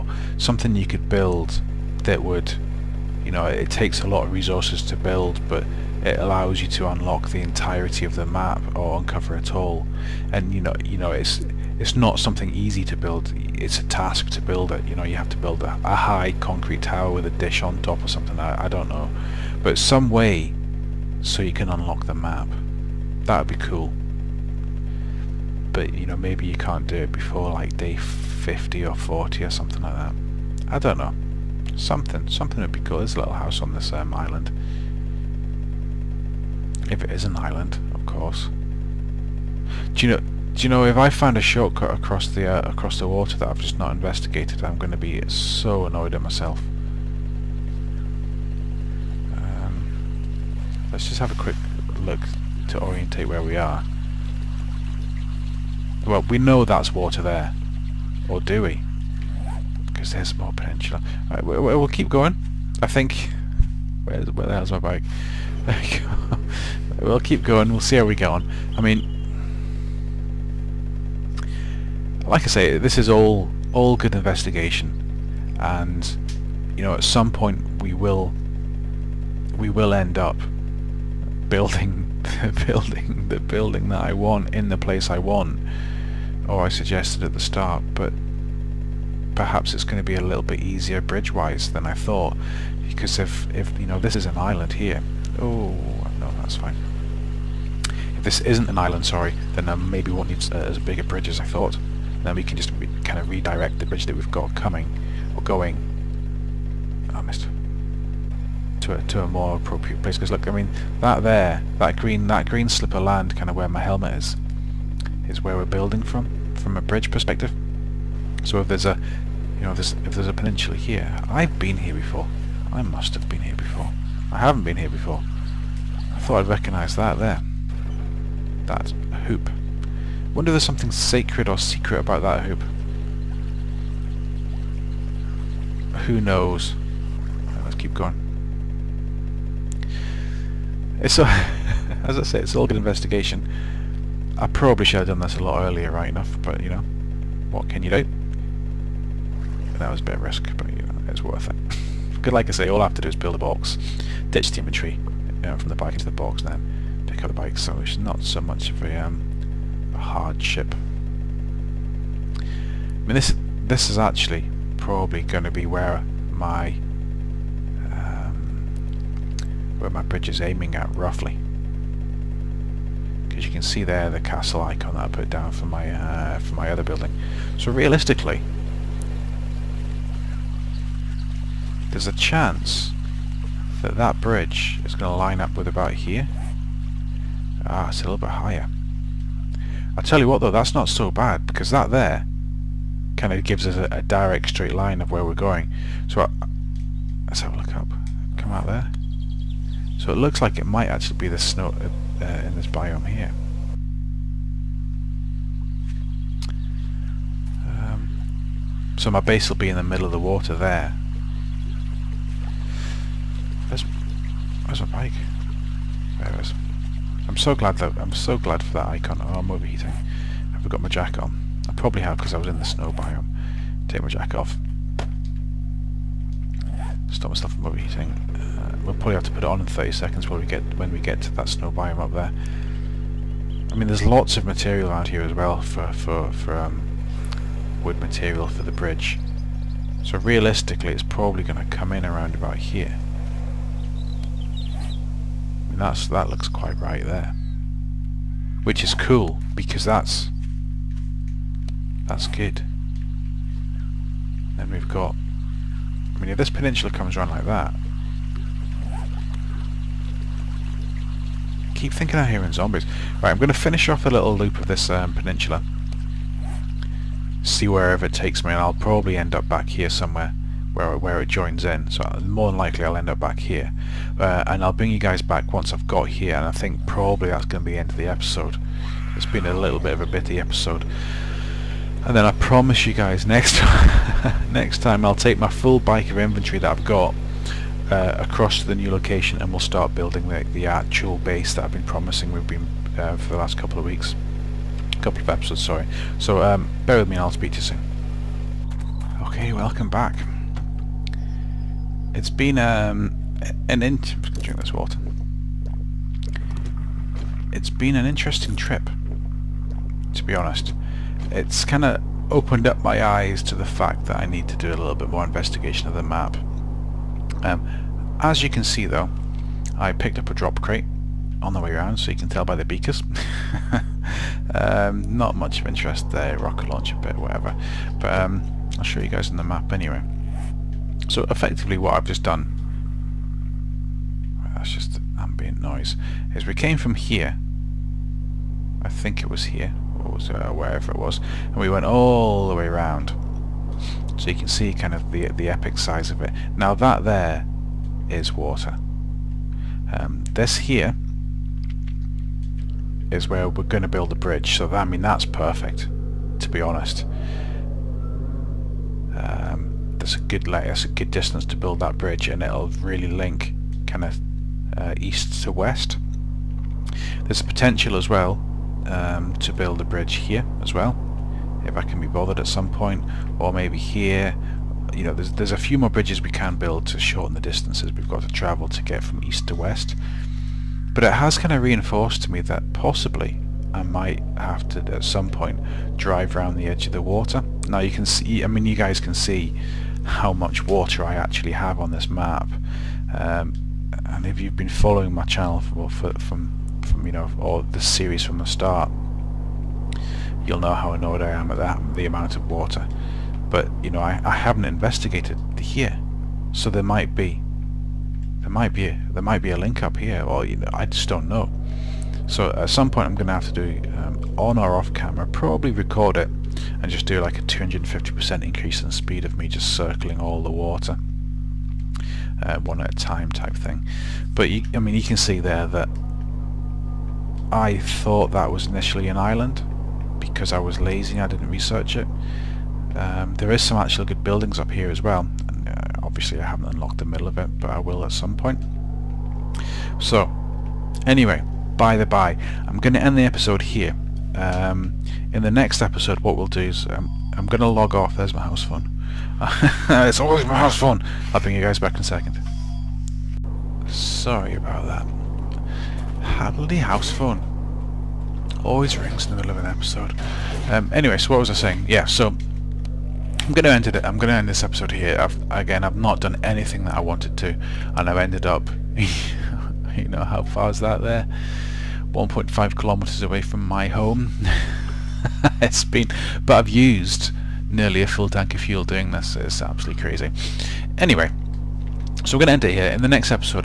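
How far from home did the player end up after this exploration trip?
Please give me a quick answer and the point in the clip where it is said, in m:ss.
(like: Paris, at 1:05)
1.5 kilometers, at 7:52.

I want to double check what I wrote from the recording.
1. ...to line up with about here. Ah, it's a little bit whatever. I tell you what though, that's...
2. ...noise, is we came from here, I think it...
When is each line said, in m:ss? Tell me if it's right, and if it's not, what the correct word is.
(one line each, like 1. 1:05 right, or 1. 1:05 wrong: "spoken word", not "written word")
1. 3:05 wrong: "higher", not "whatever"
2. 5:35 right.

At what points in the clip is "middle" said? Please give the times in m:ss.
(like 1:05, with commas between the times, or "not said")
3:29, 7:17, 7:39.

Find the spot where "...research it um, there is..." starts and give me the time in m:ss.
7:11.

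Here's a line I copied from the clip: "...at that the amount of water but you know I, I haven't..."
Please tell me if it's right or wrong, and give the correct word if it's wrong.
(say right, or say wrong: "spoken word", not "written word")
right.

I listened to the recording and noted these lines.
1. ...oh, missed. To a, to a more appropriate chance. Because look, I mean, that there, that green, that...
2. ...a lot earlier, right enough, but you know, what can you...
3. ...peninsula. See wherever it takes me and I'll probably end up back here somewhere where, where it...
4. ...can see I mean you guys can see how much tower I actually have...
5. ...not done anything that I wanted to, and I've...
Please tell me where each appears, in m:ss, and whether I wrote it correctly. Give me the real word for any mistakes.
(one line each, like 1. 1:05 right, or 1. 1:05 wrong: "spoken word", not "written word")
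1. 1:47 wrong: "place", not "chance"
2. 2:25 right
3. 4:25 right
4. 6:27 wrong: "water", not "tower"
5. 7:45 right.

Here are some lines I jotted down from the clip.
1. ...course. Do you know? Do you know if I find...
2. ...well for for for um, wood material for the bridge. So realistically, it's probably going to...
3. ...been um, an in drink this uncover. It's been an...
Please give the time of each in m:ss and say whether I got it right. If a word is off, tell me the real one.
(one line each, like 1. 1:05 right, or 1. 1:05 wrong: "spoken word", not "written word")
1. 0:38 right
2. 3:55 right
3. 5:02 wrong: "water", not "uncover".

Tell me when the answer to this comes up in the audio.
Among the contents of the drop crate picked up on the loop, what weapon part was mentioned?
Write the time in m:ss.
5:26.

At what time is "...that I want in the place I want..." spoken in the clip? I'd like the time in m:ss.
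1:23.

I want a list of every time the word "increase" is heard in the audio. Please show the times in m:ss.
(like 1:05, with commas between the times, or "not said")
6:58.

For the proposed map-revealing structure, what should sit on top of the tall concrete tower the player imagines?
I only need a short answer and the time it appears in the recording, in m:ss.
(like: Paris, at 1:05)
A dish, at 0:17.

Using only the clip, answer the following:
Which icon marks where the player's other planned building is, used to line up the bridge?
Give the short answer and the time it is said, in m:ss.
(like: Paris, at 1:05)
Castle icon, at 2:54.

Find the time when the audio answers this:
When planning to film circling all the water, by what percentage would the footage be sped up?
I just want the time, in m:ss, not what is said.
6:57.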